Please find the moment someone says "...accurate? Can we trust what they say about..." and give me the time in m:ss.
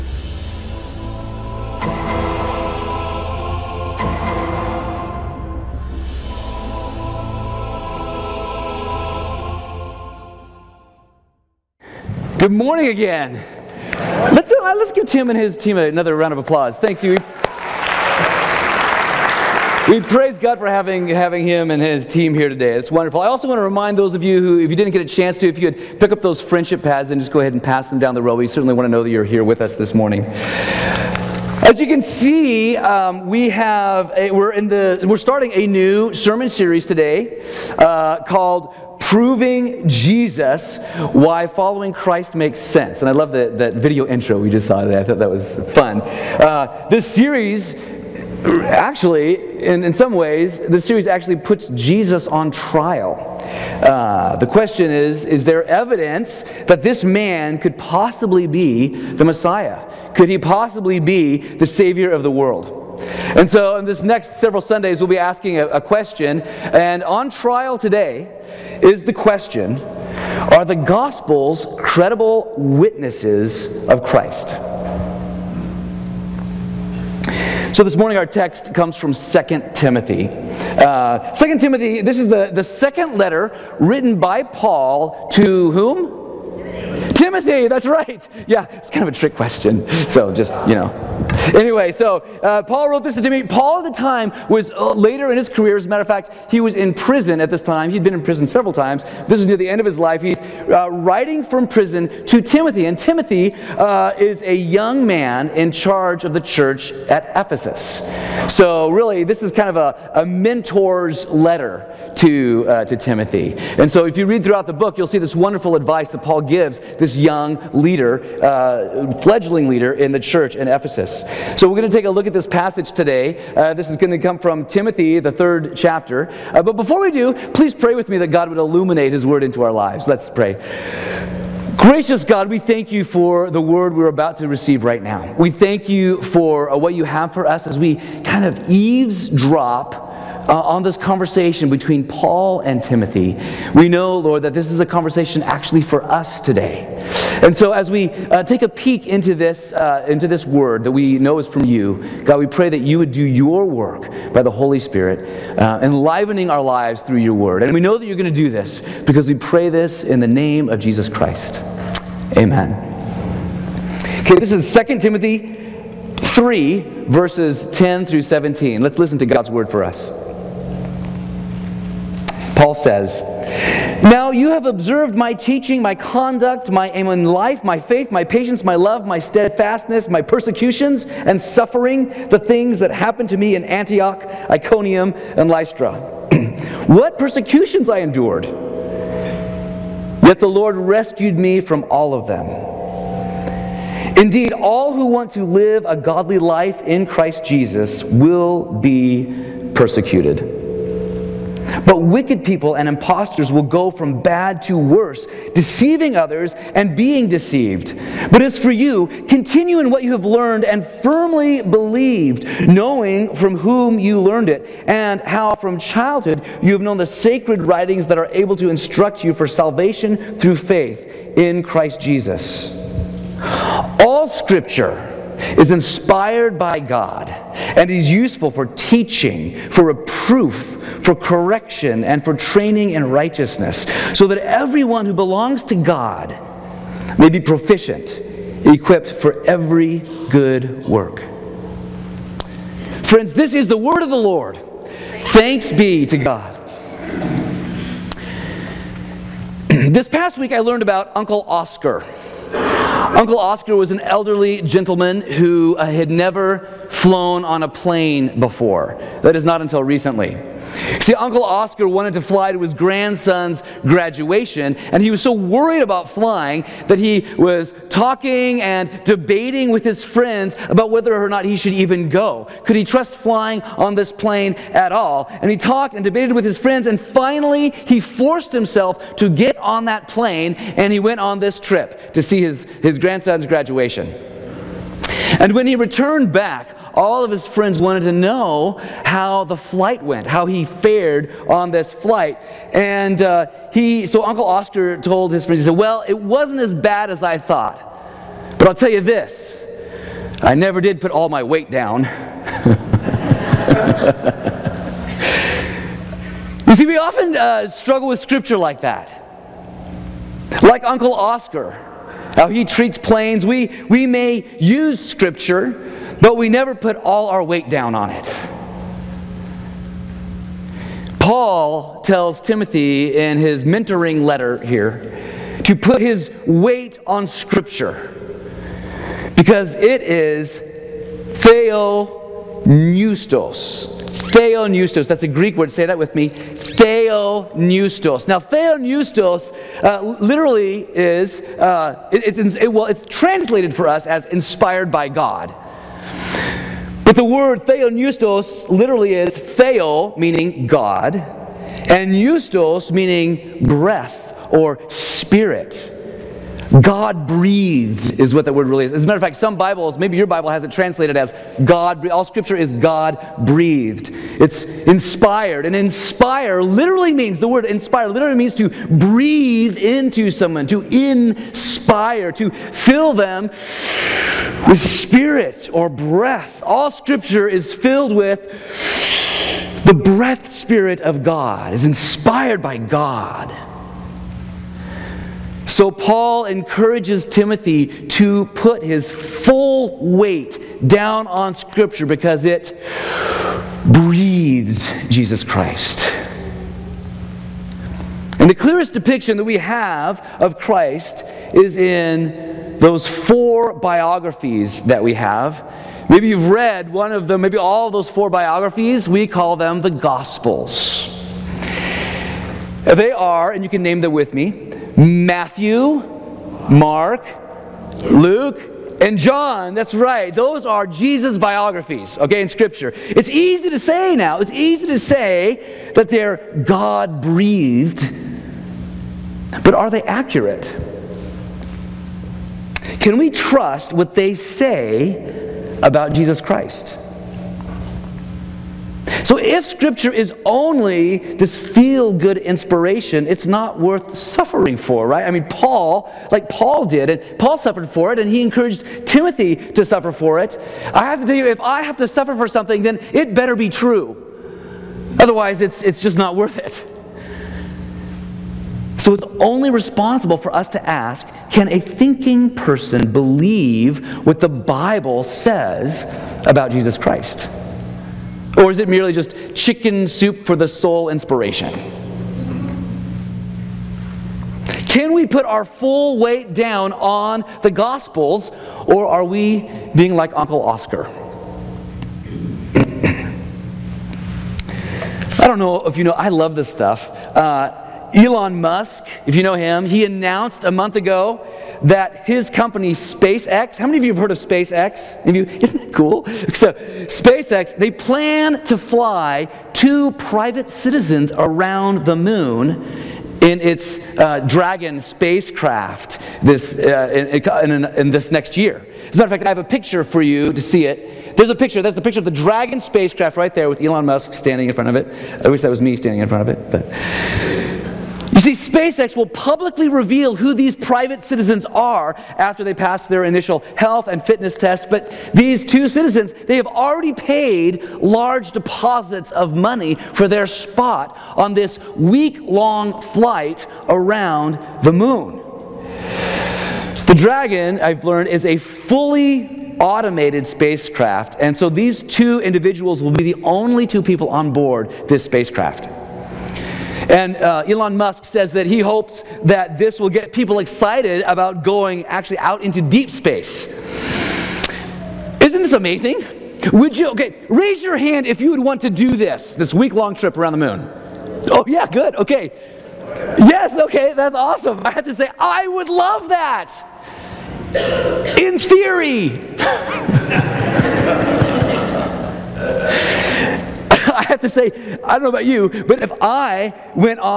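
7:10.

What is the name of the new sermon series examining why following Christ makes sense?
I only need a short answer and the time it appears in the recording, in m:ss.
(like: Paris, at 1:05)
Proving Jesus, at 0:39.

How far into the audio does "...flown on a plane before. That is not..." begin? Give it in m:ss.
4:16.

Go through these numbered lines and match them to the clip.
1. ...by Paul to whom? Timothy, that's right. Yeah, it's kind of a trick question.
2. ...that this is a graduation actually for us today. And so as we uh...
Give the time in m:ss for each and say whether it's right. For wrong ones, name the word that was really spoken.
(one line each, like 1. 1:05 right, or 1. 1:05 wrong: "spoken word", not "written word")
1. 1:24 right
2. 2:24 wrong: "conversation", not "graduation".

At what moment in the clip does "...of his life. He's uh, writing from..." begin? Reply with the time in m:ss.
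1:39.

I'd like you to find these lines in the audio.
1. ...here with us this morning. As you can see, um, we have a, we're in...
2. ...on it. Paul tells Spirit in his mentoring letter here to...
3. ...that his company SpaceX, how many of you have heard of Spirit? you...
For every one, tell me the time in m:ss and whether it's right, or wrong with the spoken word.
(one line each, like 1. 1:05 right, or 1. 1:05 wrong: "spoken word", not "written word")
1. 0:29 right
2. 5:17 wrong: "Timothy", not "Spirit"
3. 8:11 wrong: "SpaceX", not "Spirit".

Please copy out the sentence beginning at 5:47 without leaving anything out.
But the word theopneustos literally is theo, meaning God, and eustos, meaning breath or spirit.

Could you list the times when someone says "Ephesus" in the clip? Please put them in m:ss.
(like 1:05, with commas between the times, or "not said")
1:47, 2:00.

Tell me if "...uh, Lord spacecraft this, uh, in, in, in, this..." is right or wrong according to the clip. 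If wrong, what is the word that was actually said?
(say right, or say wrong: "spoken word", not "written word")
wrong: "Dragon", not "Lord".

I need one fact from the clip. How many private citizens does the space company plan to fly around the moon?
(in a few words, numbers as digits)
2.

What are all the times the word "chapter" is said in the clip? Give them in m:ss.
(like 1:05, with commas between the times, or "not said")
2:05.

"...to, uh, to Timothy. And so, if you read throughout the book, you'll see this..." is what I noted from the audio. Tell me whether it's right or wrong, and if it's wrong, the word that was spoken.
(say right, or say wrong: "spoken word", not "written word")
right.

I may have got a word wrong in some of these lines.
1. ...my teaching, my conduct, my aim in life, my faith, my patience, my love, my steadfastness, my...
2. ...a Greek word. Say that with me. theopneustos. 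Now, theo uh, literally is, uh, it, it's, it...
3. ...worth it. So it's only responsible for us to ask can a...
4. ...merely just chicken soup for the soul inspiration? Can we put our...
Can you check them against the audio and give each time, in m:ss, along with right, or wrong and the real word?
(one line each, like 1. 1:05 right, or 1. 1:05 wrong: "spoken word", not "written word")
1. 2:55 right
2. 5:35 right
3. 7:36 right
4. 7:48 right.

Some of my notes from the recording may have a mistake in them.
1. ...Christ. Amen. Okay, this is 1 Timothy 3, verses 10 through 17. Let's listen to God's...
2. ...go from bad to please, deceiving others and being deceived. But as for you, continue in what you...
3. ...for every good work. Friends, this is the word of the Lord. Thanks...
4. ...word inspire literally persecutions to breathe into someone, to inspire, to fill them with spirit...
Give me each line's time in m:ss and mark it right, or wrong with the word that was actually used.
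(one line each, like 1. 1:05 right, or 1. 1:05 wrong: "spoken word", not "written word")
1. 2:41 wrong: "2", not "1"
2. 3:23 wrong: "worse", not "please"
3. 3:59 right
4. 6:07 wrong: "means", not "persecutions".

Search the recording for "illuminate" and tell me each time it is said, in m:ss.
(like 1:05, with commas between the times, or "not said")
2:08.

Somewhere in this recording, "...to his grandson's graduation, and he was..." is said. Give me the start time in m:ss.
4:22.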